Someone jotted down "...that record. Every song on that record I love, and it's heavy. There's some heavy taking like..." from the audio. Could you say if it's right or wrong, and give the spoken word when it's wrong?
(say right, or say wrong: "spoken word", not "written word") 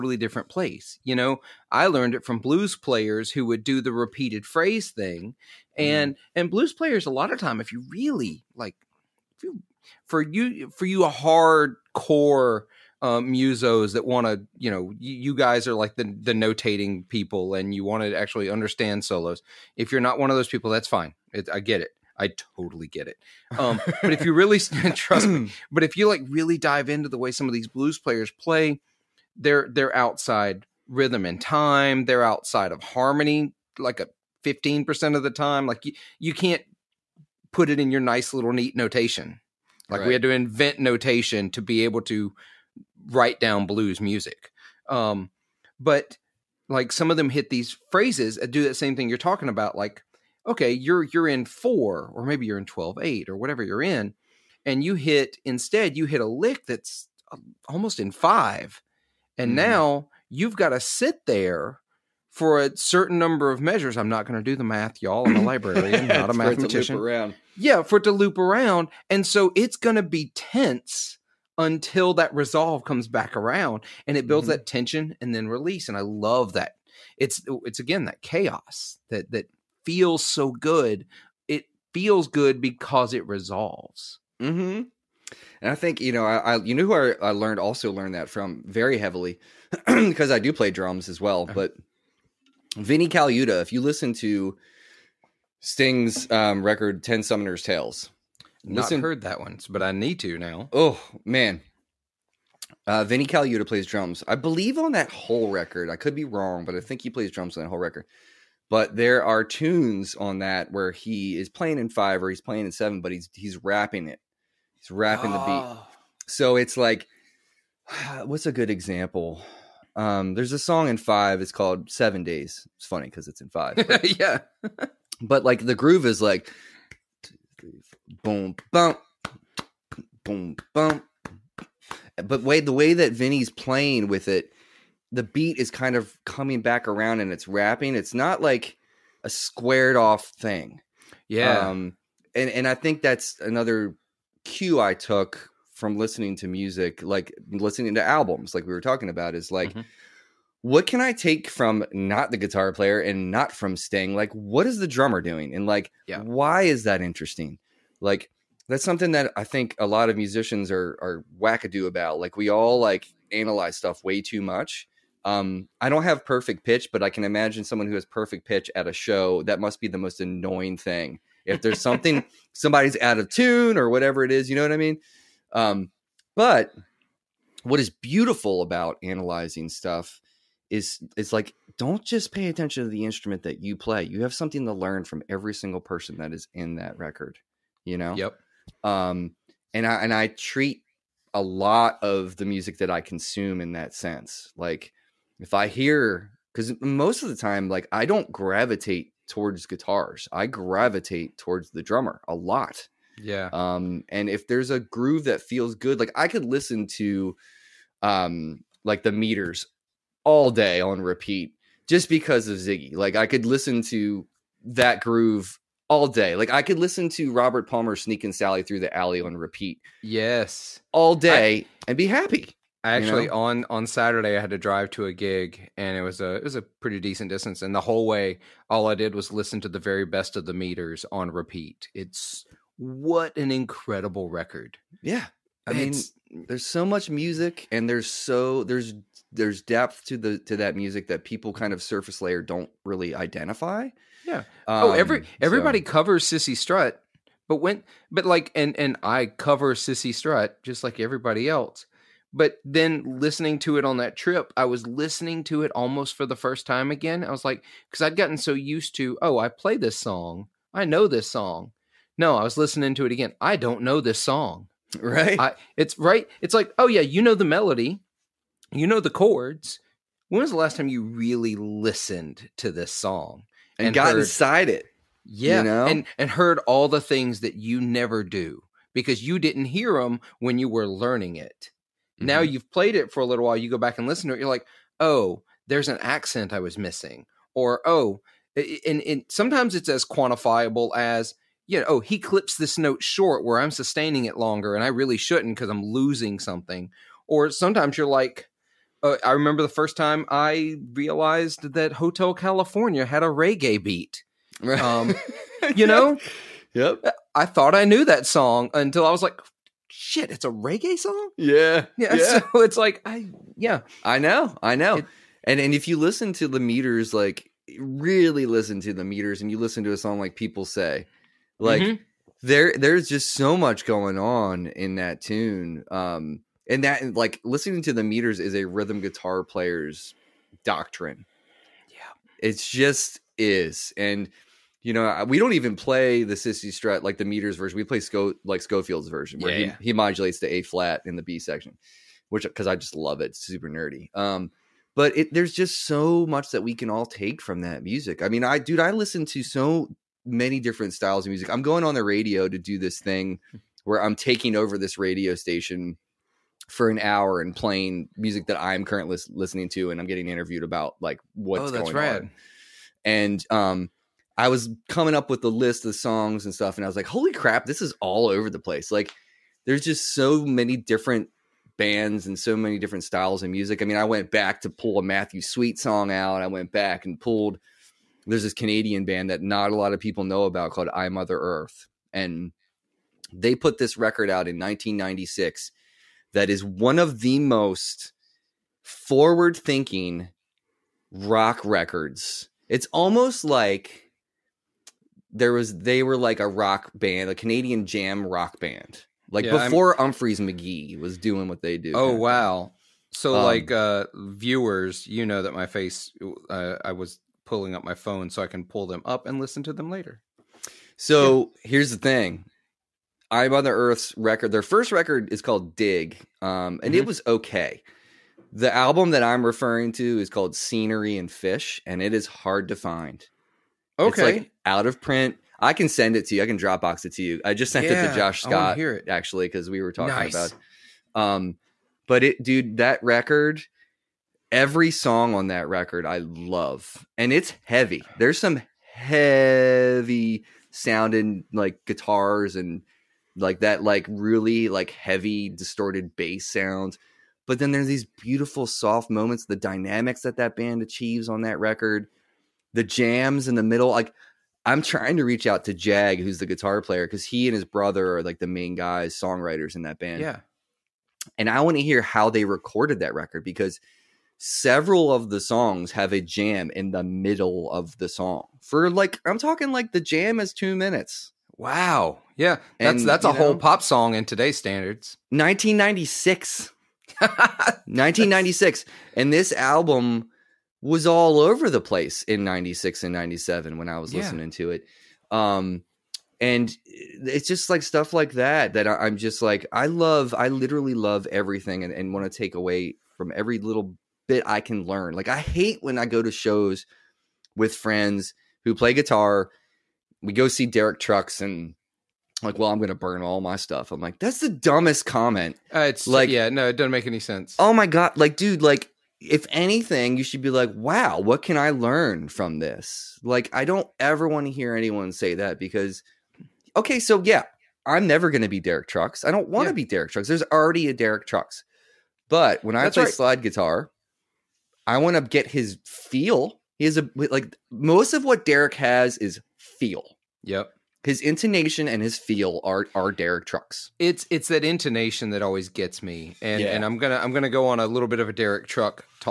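wrong: "sounding", not "taking".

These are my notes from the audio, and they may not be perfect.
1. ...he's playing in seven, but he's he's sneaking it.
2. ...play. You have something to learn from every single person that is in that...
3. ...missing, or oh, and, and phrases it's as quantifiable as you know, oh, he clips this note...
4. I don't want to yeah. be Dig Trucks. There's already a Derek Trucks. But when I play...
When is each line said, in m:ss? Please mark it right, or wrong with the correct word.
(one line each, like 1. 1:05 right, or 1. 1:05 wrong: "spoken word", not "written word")
1. 1:52 wrong: "wrapping", not "sneaking"
2. 3:03 right
3. 4:46 wrong: "sometimes", not "phrases"
4. 8:39 wrong: "Derek", not "Dig".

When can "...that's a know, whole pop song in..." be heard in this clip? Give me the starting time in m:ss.
7:53.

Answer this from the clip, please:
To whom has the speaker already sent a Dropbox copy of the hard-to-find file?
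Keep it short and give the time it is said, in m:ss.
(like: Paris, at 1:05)
Josh Scott, at 7:08.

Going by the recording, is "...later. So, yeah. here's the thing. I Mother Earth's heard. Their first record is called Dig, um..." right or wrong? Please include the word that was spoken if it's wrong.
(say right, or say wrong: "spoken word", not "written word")
wrong: "record", not "heard".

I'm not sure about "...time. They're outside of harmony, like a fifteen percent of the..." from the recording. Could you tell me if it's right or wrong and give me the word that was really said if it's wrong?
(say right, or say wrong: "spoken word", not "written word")
right.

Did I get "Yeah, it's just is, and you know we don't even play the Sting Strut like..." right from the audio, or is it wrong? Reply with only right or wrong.
wrong.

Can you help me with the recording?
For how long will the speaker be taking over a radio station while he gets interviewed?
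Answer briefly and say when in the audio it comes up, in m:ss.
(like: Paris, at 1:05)
An hour, at 5:56.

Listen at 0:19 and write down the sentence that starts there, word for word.
If you're not one of those people, that's fine.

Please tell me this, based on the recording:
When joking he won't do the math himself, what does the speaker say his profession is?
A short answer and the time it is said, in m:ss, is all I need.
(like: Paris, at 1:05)
Librarian, at 1:05.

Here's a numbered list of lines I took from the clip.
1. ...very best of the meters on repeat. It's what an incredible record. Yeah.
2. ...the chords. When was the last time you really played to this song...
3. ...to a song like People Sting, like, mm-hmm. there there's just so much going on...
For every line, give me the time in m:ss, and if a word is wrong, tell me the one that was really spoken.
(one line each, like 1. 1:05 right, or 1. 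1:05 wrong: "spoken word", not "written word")
1. 3:49 right
2. 4:28 wrong: "listened", not "played"
3. 5:19 wrong: "Say", not "Sting".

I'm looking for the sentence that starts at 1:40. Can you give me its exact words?
Oh man, uh, Vinnie Colaiuta plays drums.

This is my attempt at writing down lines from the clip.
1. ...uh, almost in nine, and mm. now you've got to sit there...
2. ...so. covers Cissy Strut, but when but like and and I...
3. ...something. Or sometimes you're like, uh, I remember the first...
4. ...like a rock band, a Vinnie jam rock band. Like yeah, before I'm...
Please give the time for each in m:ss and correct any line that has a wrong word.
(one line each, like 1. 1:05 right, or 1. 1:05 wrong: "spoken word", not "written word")
1. 0:57 wrong: "five", not "nine"
2. 4:05 right
3. 4:56 right
4. 6:36 wrong: "Canadian", not "Vinnie".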